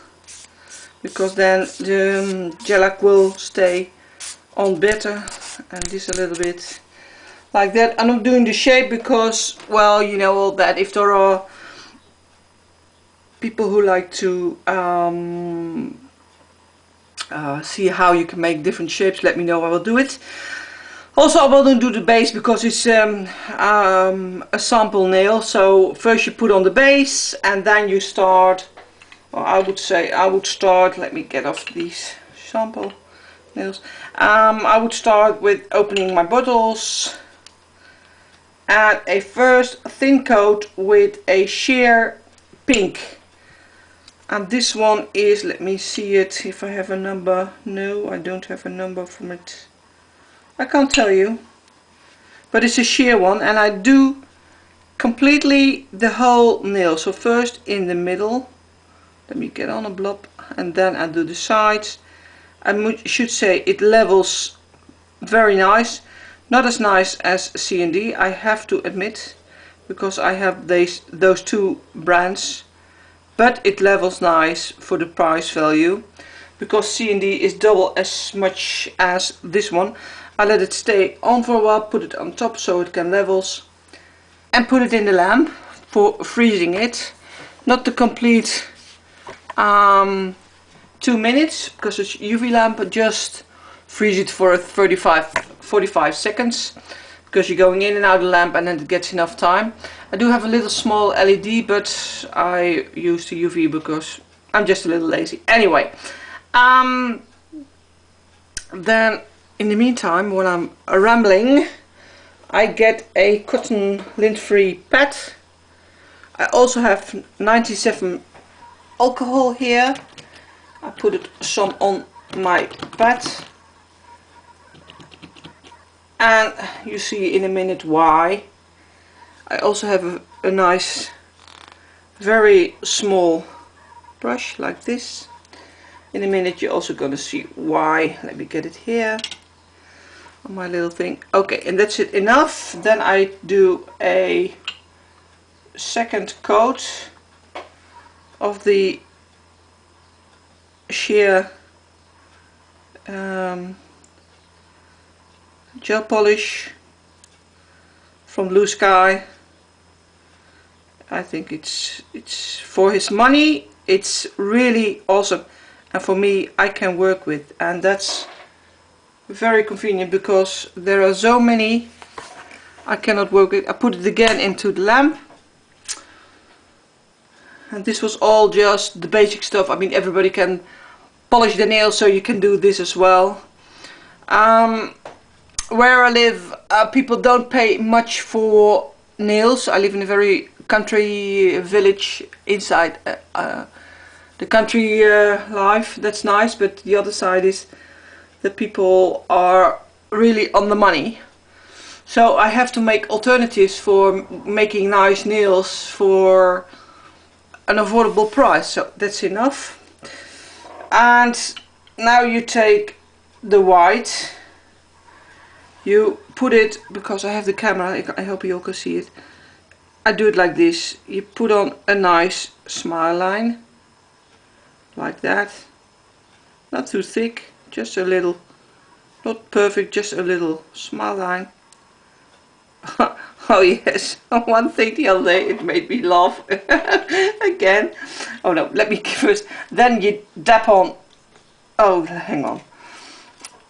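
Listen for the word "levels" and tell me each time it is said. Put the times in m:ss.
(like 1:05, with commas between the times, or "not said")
1:03, 1:13, 1:23.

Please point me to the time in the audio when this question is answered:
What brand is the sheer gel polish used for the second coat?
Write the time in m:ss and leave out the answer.
2:38.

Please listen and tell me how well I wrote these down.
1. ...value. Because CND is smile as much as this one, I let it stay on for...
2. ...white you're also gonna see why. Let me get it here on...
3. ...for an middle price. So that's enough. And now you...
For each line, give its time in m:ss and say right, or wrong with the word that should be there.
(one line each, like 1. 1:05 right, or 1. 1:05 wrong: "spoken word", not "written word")
1. 1:15 wrong: "double", not "smile"
2. 2:16 wrong: "minute", not "white"
3. 3:25 wrong: "affordable", not "middle".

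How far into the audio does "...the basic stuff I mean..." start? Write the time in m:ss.
2:58.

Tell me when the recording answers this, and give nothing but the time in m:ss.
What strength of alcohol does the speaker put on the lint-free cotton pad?
1:57.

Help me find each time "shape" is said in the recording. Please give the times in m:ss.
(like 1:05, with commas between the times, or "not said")
0:08, 0:18.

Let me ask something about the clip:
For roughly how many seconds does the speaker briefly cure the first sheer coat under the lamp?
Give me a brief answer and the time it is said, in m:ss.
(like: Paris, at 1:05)
35 45 seconds, at 1:34.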